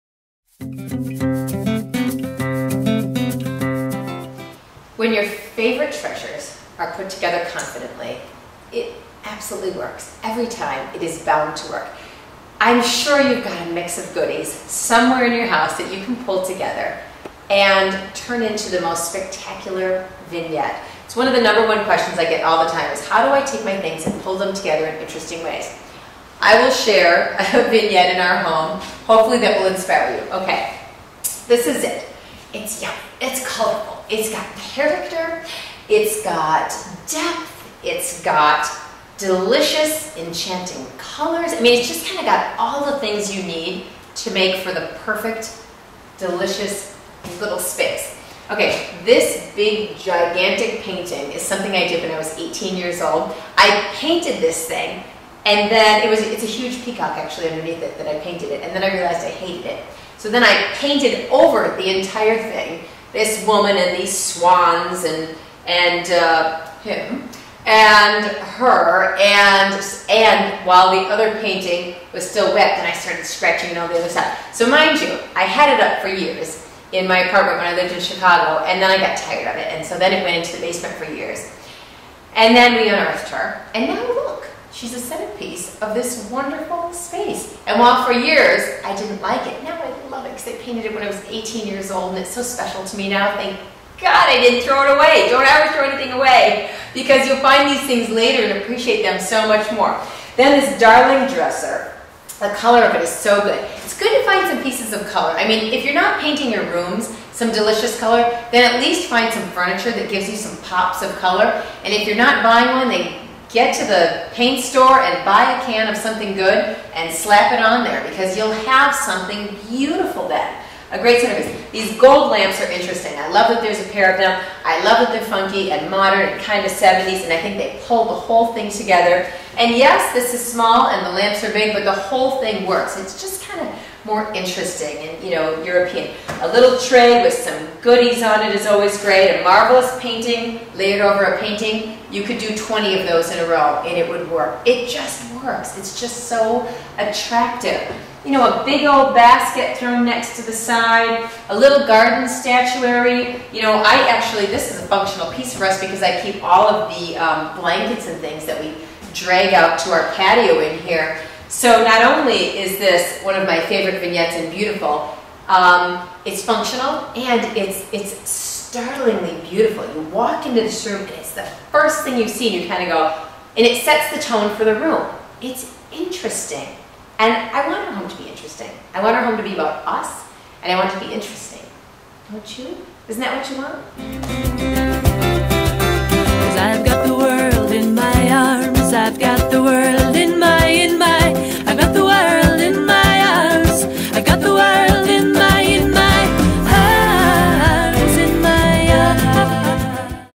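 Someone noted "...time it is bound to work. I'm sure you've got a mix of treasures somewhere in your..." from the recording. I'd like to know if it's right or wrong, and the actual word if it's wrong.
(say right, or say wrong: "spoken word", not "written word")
wrong: "goodies", not "treasures".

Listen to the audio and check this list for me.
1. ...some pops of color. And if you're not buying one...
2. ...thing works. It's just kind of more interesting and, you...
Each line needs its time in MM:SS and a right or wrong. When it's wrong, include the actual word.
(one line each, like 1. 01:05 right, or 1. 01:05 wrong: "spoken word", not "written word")
1. 01:50 right
2. 02:12 right.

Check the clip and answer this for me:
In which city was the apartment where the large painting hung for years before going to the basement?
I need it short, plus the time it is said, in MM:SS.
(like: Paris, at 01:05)
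Chicago, at 01:17.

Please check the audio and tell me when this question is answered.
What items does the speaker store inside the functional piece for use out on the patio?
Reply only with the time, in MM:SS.
02:37.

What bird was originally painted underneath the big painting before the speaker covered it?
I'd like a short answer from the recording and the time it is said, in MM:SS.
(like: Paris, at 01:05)
peacock, at 00:56.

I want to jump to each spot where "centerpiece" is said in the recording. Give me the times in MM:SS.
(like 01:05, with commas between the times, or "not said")
01:24, 02:01.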